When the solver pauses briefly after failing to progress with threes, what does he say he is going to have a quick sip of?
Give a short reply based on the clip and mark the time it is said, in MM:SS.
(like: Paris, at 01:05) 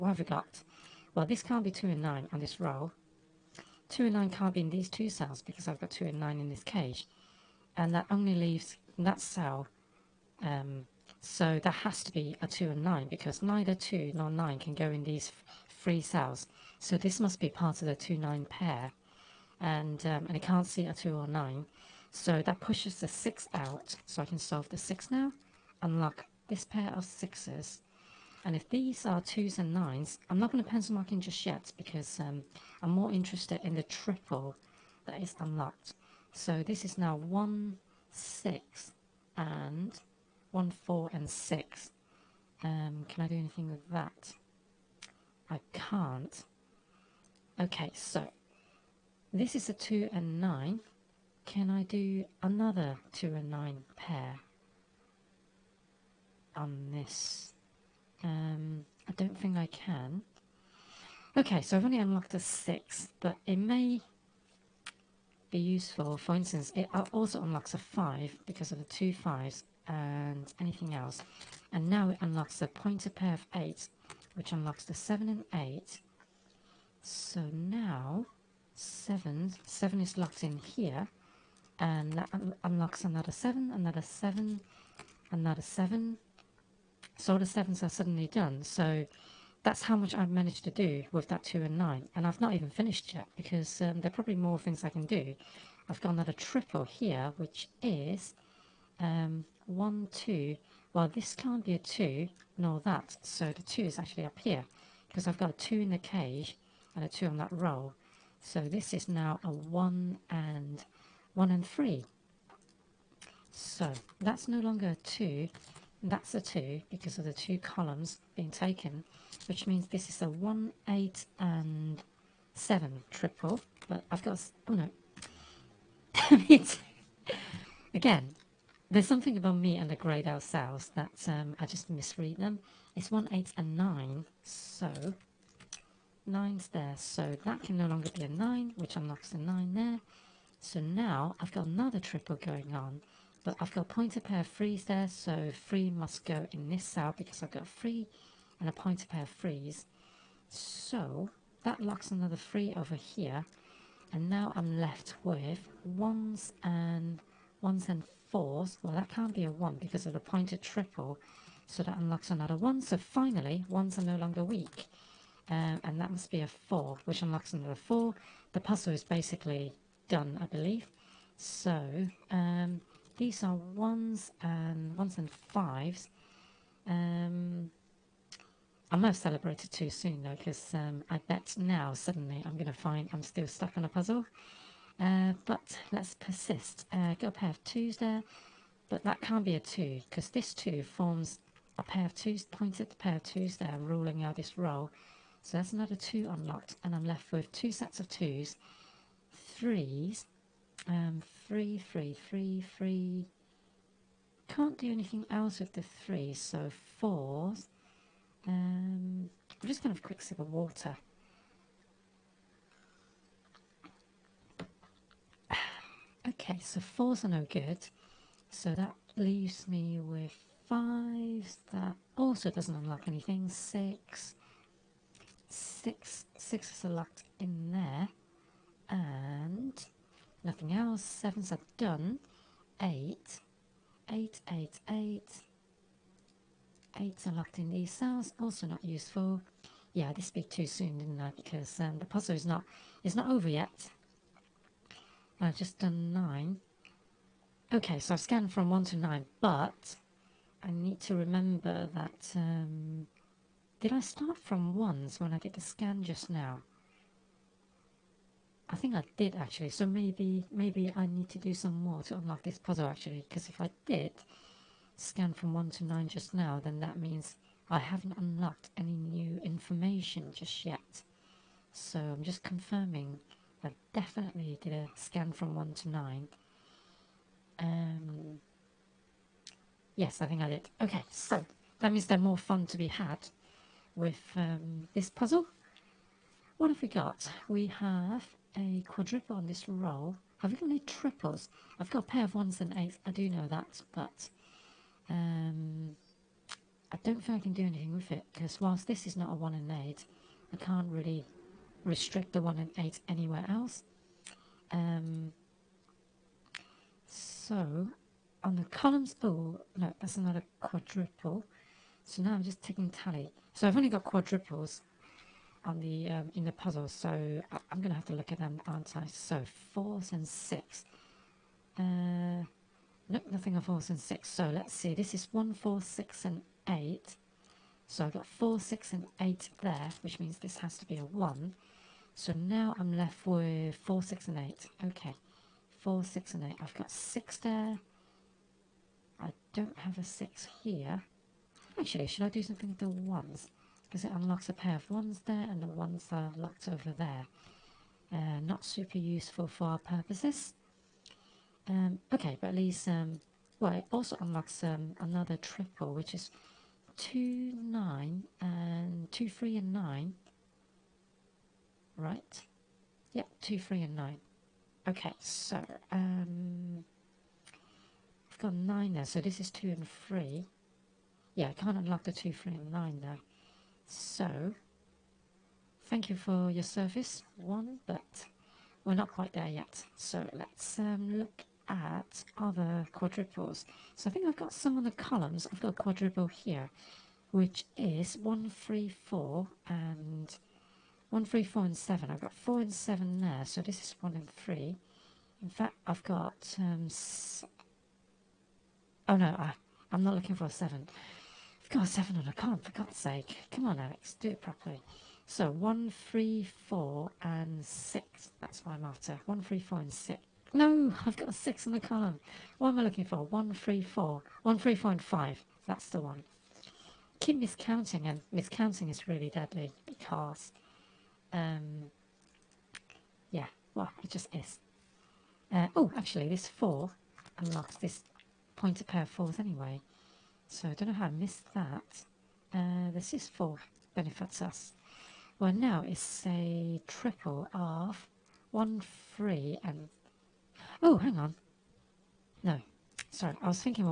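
water, at 03:30.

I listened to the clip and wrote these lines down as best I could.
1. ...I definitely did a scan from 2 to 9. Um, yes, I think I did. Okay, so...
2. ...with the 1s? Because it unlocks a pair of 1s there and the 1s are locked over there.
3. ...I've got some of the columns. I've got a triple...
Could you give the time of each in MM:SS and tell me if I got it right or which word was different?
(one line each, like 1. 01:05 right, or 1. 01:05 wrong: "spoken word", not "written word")
1. 04:33 wrong: "1", not "2"
2. 05:42 right
3. 06:24 wrong: "quadruple", not "triple".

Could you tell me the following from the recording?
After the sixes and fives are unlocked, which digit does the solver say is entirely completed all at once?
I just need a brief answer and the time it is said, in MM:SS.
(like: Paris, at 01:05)
7, at 01:27.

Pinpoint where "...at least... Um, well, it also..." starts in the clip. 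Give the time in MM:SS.
05:52.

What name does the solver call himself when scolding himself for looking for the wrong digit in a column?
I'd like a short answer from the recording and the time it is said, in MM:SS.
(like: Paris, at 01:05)
Alex, at 06:43.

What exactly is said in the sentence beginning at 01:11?
And now it unlocks the pointer pair of 8, which unlocks the 7 and 8.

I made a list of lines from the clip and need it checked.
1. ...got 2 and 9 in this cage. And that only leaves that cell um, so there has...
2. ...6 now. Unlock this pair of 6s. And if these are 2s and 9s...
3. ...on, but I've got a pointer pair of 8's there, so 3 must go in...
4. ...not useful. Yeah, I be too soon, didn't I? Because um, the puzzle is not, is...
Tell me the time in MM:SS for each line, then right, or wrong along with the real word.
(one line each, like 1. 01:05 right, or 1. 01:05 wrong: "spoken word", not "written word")
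1. 00:05 right
2. 00:24 right
3. 02:22 wrong: "3", not "8"
4. 03:58 right.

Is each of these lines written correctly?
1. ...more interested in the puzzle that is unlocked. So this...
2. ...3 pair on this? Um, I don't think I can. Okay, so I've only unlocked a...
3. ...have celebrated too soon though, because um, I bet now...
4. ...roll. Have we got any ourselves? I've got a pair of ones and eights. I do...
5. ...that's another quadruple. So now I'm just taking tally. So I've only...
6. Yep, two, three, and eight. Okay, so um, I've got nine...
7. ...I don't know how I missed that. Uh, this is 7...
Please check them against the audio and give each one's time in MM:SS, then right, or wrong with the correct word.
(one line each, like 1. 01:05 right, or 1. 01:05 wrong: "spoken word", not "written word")
1. 00:32 wrong: "triple", not "puzzle"
2. 00:53 wrong: "9", not "3"
3. 02:59 right
4. 04:49 wrong: "triples", not "ourselves"
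5. 05:09 right
6. 06:03 wrong: "nine", not "eight"
7. 07:10 wrong: "4", not "7".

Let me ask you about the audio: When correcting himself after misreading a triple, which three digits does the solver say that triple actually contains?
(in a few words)
1, 8 and 9.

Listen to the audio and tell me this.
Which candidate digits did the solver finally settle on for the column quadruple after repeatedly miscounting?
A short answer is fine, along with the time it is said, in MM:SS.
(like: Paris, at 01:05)
1, 3 and 5, at 06:54.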